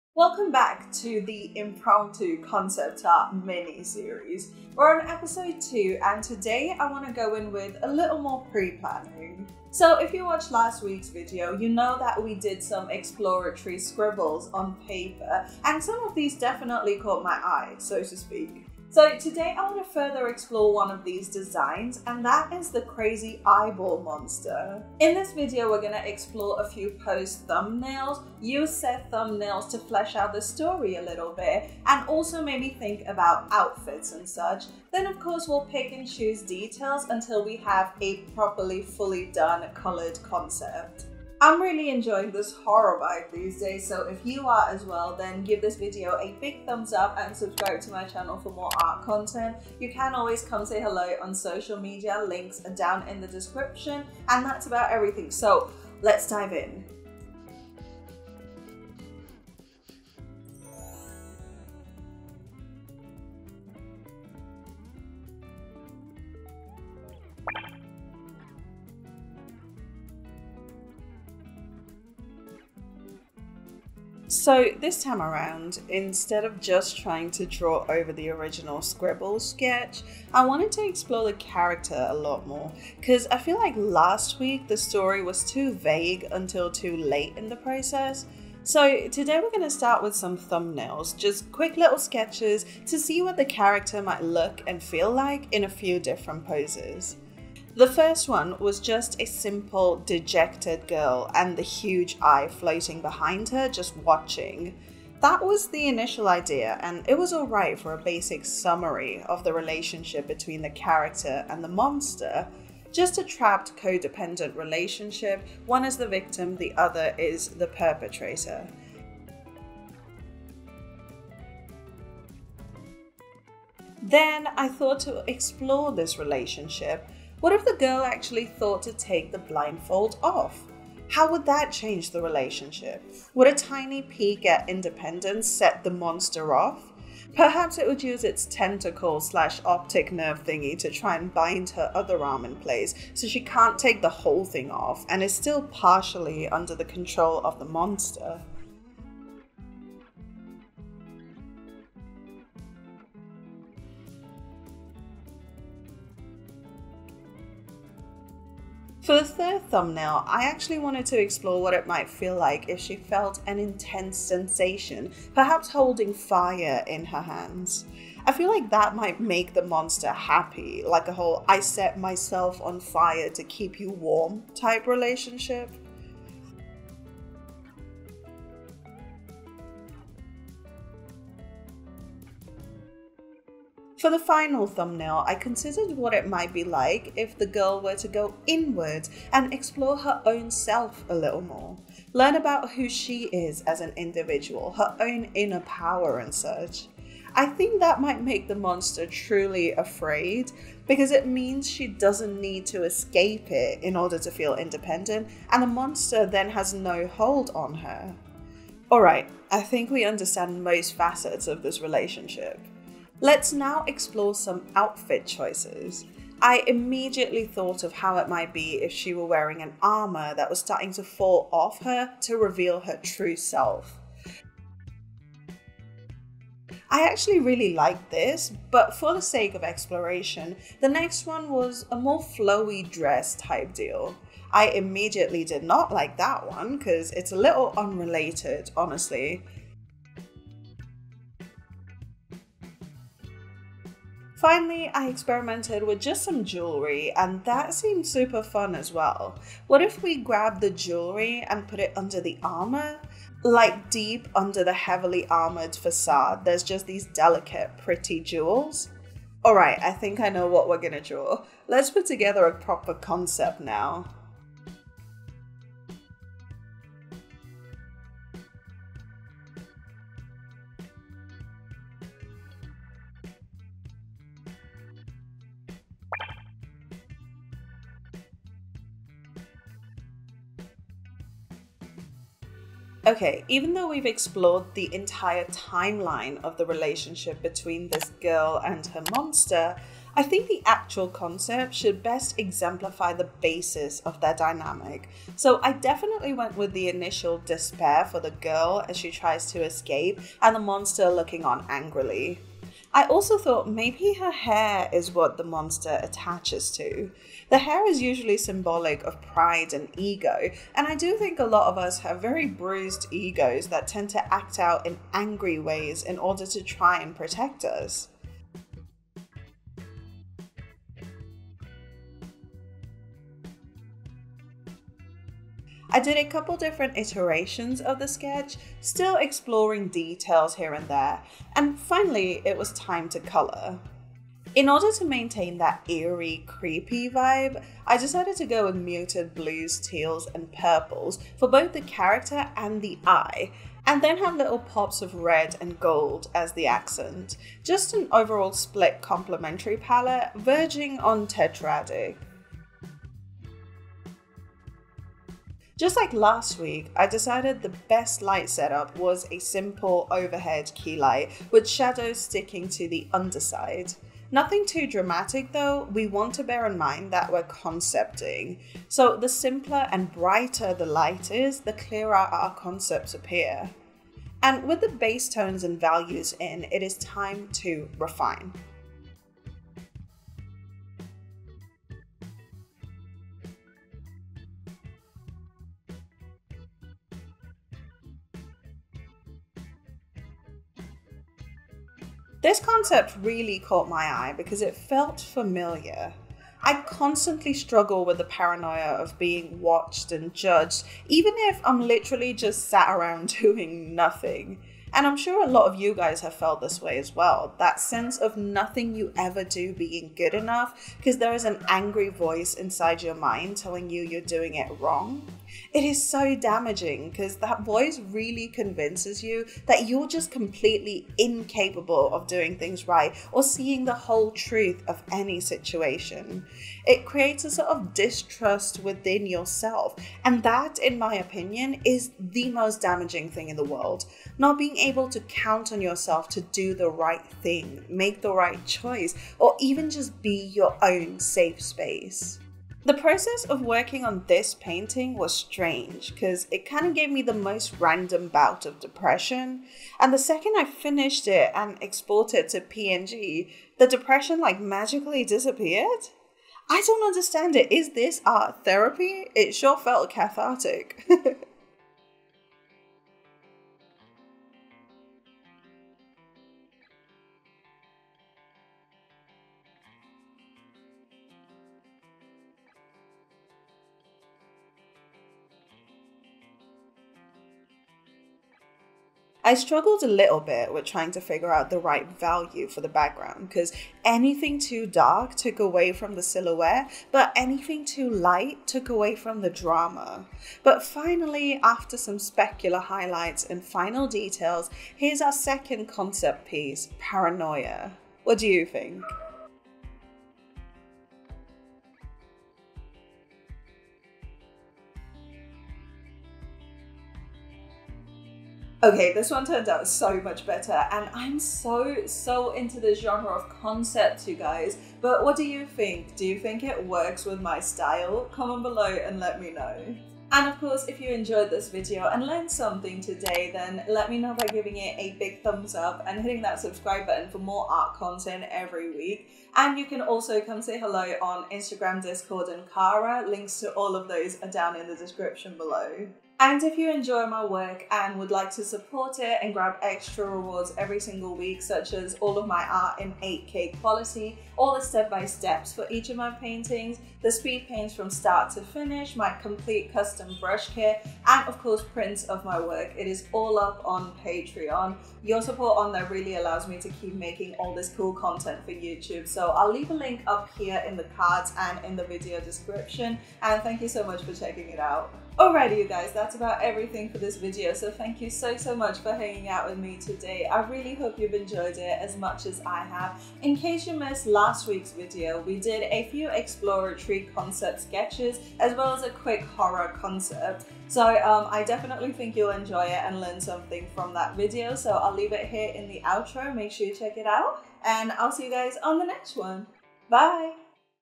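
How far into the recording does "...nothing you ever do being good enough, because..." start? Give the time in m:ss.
6:48.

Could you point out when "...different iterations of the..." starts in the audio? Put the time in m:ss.
5:26.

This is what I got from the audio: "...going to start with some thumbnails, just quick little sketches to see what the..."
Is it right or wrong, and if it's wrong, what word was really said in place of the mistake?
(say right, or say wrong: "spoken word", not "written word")
right.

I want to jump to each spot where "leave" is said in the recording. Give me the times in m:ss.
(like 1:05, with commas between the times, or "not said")
9:19, 9:45.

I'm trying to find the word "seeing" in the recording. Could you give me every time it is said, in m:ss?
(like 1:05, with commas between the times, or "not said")
7:03.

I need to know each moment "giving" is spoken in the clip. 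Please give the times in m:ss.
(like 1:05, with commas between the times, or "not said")
8:44.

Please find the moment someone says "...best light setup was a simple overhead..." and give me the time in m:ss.
5:57.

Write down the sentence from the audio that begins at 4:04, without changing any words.
Finally, I experimented with just some jewelry and that seemed super fun as well.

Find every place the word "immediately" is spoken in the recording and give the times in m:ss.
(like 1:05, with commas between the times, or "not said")
3:36, 3:54.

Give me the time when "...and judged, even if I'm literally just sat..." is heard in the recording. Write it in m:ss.
6:40.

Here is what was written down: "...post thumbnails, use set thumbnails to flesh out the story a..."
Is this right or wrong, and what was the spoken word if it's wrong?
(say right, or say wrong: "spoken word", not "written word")
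right.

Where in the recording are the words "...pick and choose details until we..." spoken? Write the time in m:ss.
0:35.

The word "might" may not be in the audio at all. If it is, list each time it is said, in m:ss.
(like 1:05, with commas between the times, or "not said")
1:34, 2:41, 2:48, 3:06, 3:18, 3:38.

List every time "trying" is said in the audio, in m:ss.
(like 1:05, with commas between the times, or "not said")
1:16, 8:00.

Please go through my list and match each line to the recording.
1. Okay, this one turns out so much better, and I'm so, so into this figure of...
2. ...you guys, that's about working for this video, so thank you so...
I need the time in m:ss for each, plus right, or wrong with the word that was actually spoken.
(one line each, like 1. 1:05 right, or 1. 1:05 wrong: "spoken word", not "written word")
1. 8:28 wrong: "genre", not "figure"
2. 9:25 wrong: "everything", not "working".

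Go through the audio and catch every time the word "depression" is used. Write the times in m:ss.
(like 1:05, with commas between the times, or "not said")
7:28, 7:33.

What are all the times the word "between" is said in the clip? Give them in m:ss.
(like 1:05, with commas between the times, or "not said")
1:50, 4:47.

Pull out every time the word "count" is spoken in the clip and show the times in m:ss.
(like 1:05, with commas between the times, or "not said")
7:15.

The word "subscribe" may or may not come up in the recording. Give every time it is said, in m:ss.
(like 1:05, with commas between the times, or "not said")
0:47, 8:46.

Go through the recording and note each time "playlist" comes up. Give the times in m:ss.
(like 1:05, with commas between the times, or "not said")
not said.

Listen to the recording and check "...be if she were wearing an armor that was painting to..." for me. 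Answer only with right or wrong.
wrong.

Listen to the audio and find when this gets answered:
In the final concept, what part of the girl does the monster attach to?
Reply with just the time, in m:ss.
5:04.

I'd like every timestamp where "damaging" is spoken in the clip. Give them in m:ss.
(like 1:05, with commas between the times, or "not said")
6:56, 7:12.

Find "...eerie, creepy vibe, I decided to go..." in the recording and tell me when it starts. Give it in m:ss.
5:35.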